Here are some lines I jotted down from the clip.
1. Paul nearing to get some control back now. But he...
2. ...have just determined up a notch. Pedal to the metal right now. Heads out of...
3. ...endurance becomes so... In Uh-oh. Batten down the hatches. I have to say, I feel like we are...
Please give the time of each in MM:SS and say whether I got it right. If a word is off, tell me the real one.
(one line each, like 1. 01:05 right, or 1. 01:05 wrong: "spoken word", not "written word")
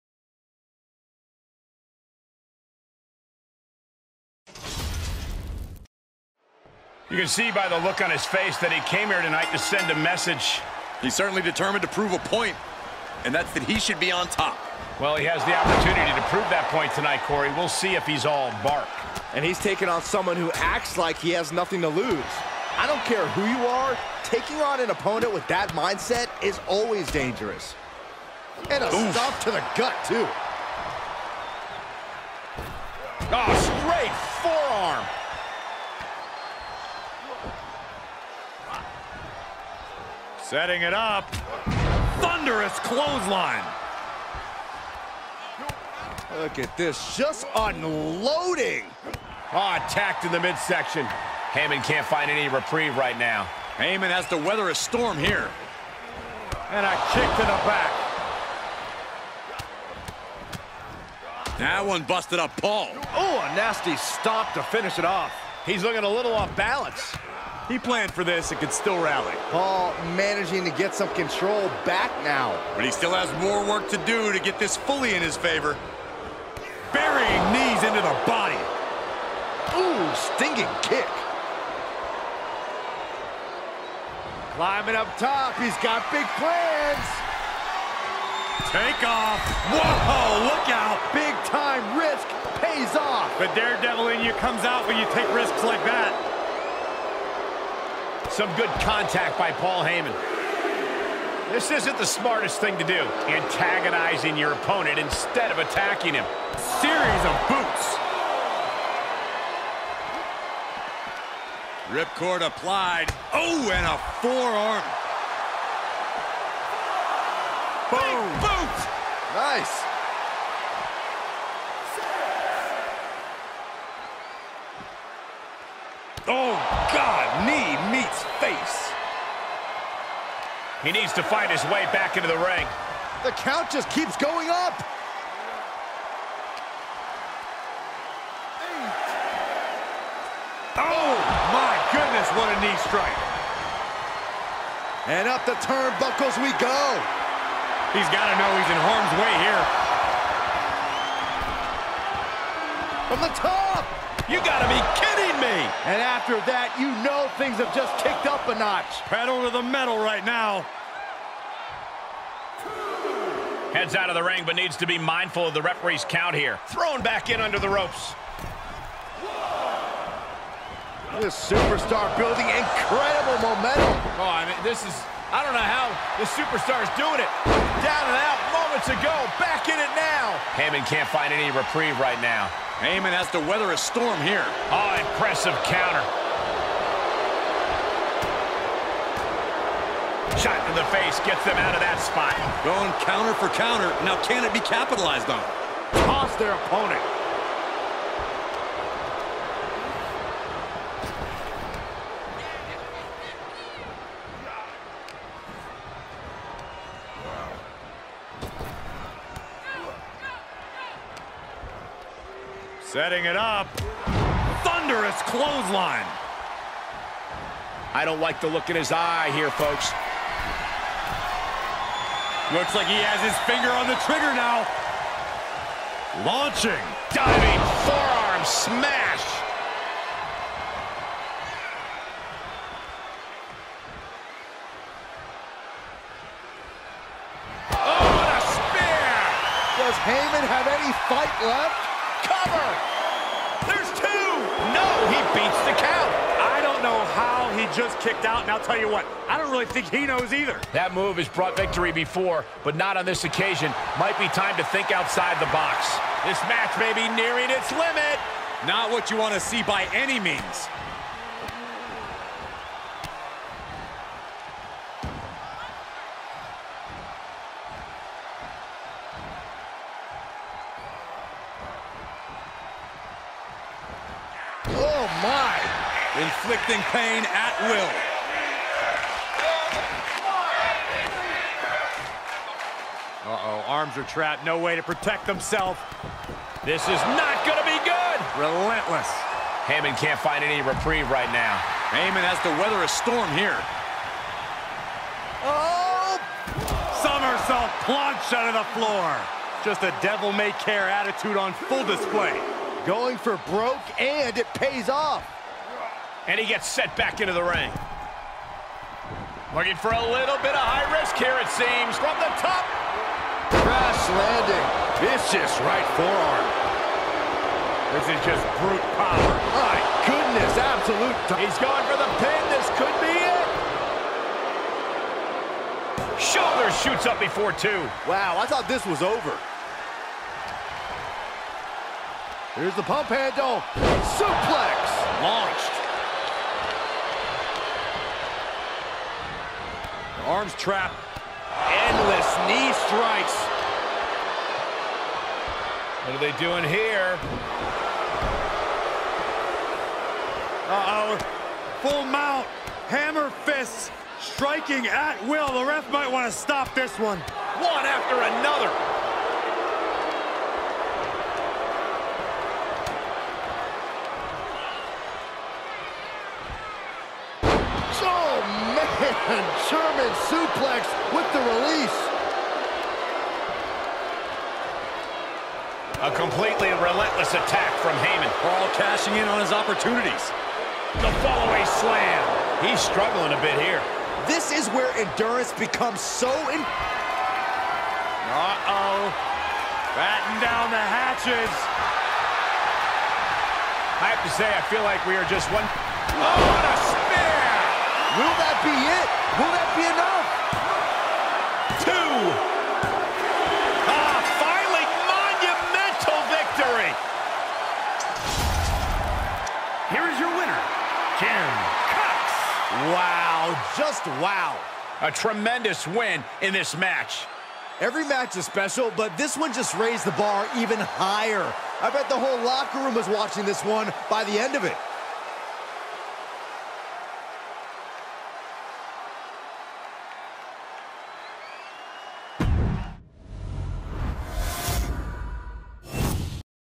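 1. 01:09 wrong: "managing", not "nearing"
2. 02:37 wrong: "kicked", not "determined"
3. 06:24 right.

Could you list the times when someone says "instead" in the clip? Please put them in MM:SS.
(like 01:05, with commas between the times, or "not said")
01:44.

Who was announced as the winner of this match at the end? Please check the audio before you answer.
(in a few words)
Jim Cox.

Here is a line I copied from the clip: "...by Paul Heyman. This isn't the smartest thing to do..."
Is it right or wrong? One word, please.
right.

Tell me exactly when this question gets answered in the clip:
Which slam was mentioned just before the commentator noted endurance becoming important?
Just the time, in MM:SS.
06:21.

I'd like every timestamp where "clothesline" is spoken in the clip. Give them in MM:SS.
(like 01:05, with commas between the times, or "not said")
00:42, 03:35.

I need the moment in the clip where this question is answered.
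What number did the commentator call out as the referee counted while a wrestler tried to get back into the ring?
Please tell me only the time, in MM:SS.
02:18.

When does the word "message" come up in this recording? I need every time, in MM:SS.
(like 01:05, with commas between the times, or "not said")
00:09.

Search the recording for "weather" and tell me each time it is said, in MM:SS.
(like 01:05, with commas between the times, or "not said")
00:54, 03:03, 04:52.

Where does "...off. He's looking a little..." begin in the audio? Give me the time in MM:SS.
01:05.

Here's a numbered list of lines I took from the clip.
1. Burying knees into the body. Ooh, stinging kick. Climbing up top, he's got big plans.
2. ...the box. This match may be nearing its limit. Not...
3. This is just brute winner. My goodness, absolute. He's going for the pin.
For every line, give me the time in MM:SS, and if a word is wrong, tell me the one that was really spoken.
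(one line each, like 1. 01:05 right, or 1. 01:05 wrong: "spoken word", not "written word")
1. 01:16 right
2. 04:15 right
3. 05:18 wrong: "power", not "winner".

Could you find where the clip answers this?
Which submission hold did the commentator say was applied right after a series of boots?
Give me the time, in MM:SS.
01:51.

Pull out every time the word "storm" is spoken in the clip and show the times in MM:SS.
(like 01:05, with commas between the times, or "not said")
00:54, 03:03, 04:52.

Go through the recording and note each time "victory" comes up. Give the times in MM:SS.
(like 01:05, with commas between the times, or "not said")
04:11, 06:46.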